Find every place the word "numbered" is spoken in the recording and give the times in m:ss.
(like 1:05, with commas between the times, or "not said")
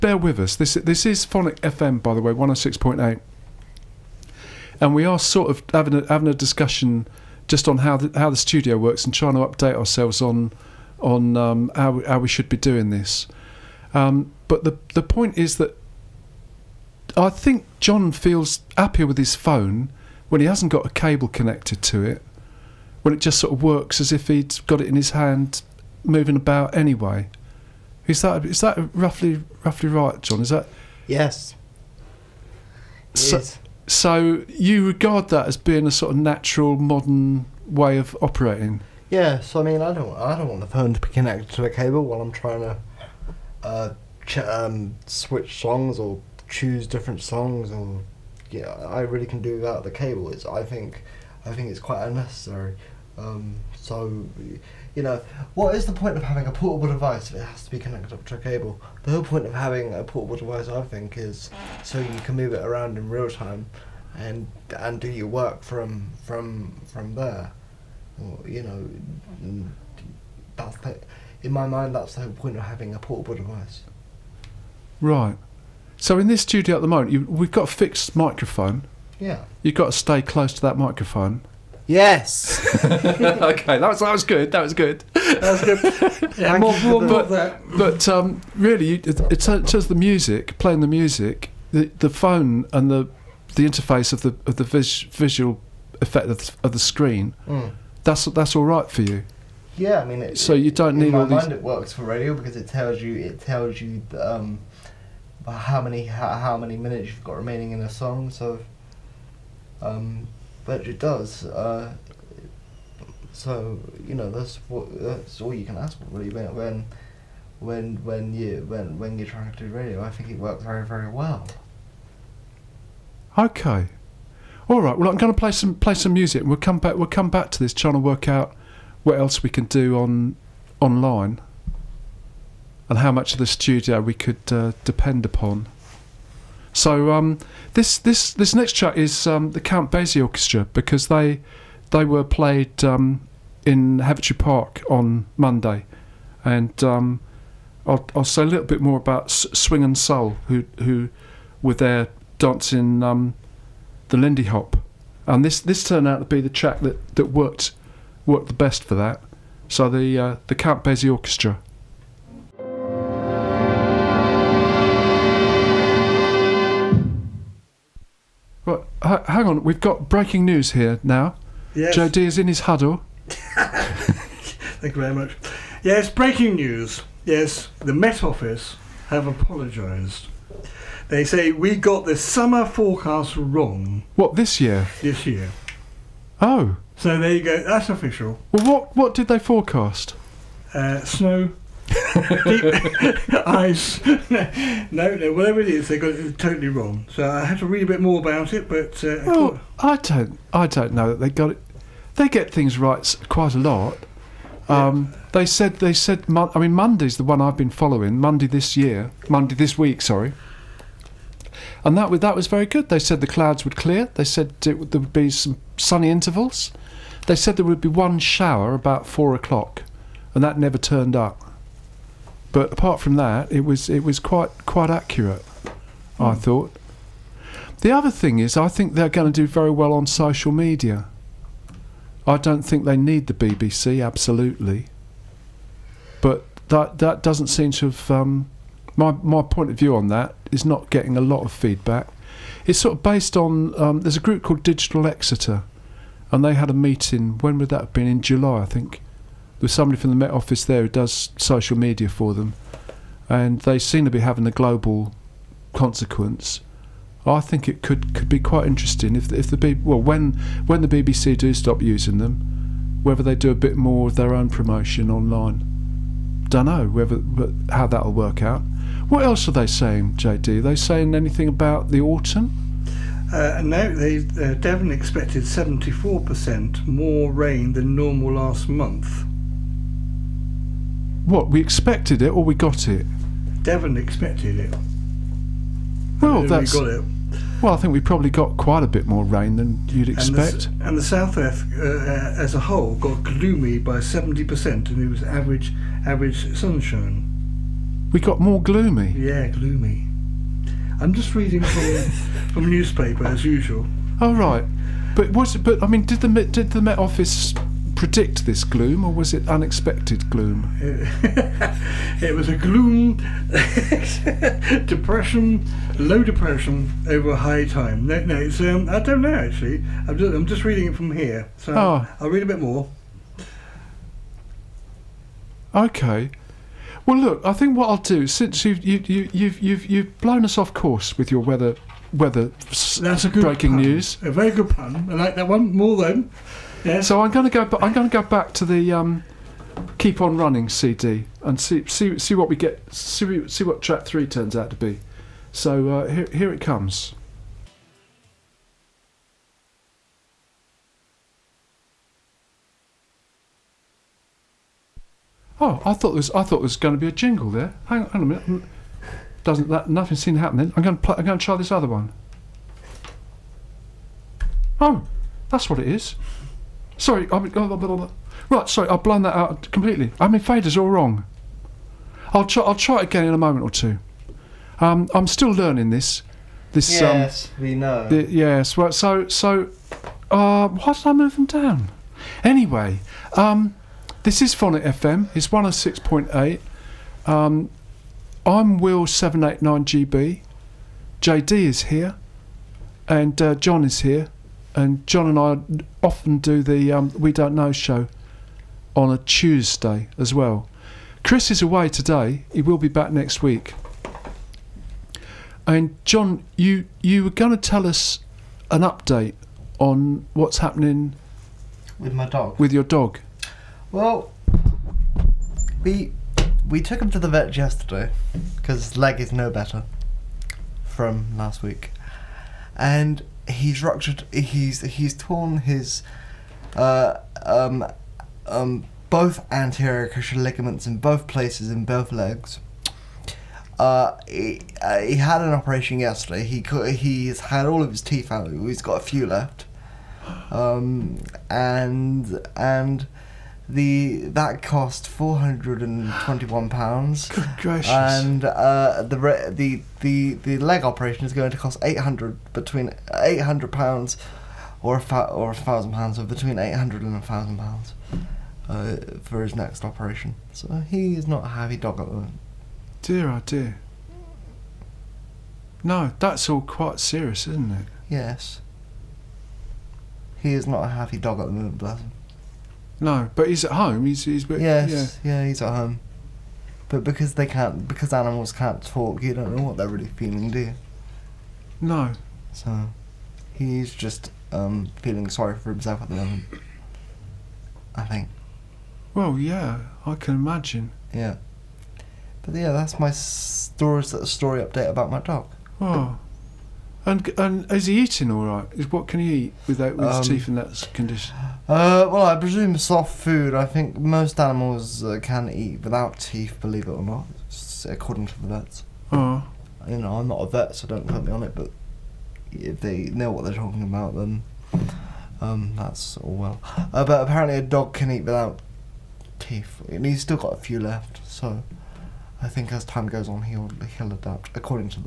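not said.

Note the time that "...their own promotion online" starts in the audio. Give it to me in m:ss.
4:24.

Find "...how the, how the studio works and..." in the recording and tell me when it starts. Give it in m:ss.
0:07.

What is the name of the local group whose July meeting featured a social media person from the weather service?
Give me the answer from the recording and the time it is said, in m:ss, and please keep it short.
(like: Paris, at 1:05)
Digital Exeter, at 4:04.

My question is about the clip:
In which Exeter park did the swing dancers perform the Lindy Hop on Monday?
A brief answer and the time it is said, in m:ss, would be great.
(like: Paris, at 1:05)
Heavitree Park, at 2:23.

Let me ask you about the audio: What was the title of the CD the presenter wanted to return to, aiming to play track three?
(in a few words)
Keep on Running.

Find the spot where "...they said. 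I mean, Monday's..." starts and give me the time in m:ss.
3:25.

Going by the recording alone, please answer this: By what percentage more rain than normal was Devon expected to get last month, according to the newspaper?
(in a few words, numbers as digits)
74%.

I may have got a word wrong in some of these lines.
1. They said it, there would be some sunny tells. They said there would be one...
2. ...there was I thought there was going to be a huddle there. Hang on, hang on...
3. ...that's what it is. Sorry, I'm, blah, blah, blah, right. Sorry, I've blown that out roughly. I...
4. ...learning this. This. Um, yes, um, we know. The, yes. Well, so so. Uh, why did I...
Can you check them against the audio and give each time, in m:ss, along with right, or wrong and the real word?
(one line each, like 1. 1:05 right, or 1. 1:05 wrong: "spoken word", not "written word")
1. 3:34 wrong: "intervals", not "tells"
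2. 5:56 wrong: "jingle", not "huddle"
3. 6:05 wrong: "completely", not "roughly"
4. 6:15 right.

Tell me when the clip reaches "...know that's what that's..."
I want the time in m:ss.
1:54.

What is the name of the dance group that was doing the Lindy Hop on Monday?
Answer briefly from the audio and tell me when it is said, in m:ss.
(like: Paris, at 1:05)
Swing and Soul, at 2:29.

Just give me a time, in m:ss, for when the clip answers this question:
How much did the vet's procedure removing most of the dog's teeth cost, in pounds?
7:25.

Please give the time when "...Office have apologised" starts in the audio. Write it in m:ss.
2:58.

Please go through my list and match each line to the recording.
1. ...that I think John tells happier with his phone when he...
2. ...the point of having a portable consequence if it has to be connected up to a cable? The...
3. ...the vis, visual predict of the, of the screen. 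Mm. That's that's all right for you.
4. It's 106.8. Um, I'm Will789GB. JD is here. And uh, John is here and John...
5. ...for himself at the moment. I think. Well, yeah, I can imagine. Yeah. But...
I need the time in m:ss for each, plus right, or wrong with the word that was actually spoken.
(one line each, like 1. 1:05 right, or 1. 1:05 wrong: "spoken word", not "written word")
1. 0:15 wrong: "feels", not "tells"
2. 0:55 wrong: "device", not "consequence"
3. 1:34 wrong: "effect", not "predict"
4. 6:25 right
5. 8:05 right.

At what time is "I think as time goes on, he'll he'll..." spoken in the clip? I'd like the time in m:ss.
8:42.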